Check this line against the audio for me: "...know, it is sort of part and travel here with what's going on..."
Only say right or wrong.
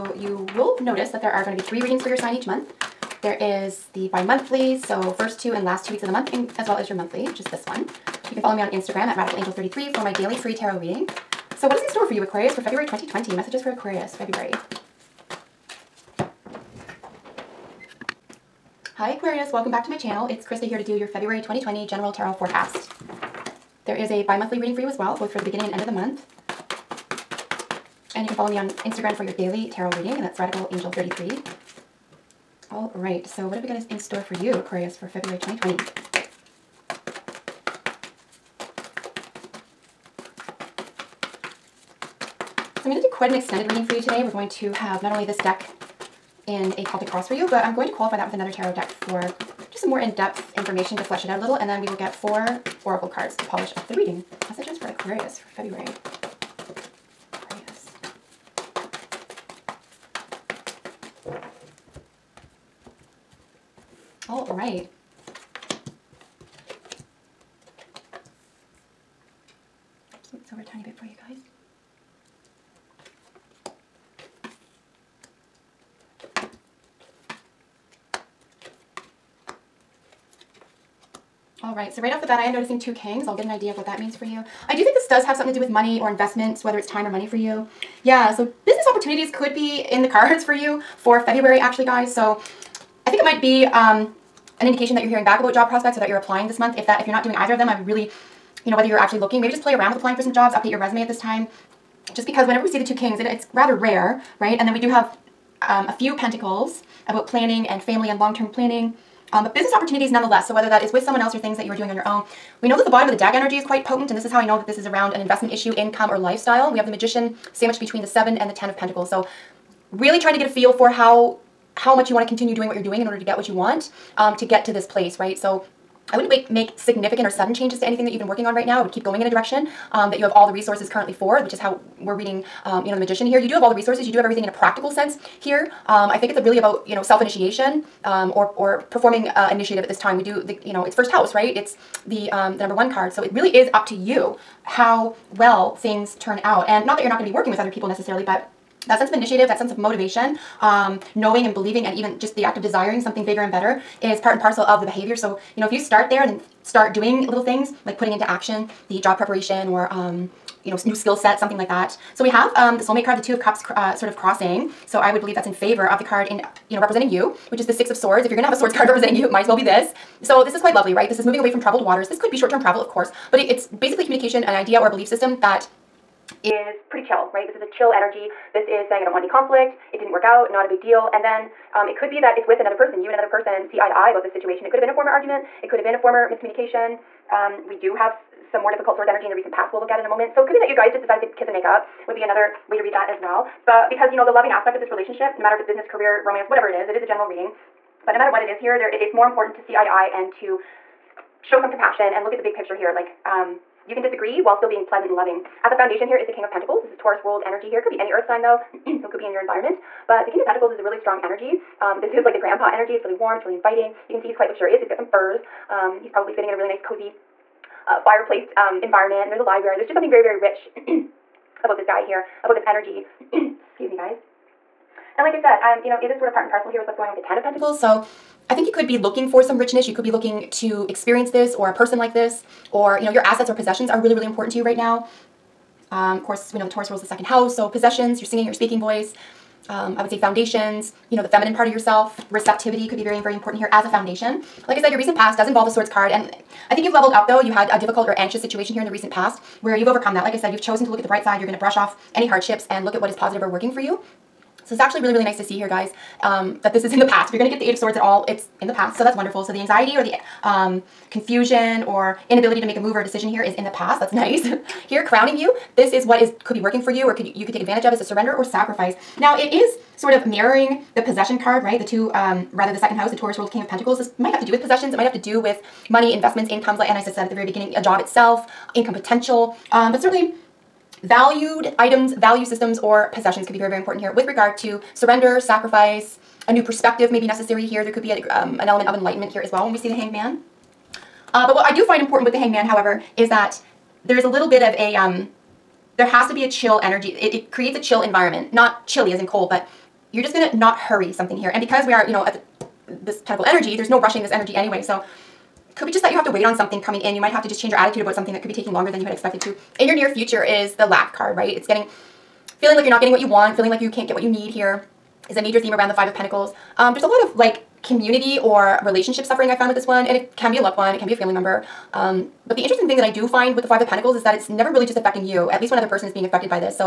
wrong.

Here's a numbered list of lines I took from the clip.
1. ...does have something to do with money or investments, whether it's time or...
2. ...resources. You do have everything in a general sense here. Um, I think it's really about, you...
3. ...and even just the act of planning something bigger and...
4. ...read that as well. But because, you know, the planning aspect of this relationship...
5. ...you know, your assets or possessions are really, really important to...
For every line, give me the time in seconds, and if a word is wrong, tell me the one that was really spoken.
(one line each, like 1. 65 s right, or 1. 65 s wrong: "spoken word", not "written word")
1. 85 s right
2. 133 s wrong: "practical", not "general"
3. 151 s wrong: "desiring", not "planning"
4. 192 s wrong: "loving", not "planning"
5. 233 s right.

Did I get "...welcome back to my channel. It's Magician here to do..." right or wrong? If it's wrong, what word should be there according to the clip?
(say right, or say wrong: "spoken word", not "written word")
wrong: "Krista", not "Magician".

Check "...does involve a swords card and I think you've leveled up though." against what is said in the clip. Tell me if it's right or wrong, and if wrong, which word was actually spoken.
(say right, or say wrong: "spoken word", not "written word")
right.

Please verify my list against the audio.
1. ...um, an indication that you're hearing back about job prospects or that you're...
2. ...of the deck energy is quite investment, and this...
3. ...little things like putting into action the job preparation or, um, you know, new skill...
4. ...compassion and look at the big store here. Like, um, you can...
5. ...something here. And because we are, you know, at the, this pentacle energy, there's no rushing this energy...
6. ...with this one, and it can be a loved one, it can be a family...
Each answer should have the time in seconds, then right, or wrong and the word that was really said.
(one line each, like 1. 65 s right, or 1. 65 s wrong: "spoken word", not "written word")
1. 93 s right
2. 113 s wrong: "potent", not "investment"
3. 157 s right
4. 201 s wrong: "picture", not "store"
5. 301 s right
6. 319 s right.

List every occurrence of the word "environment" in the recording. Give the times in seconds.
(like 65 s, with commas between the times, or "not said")
209 s, 218 s, 298 s.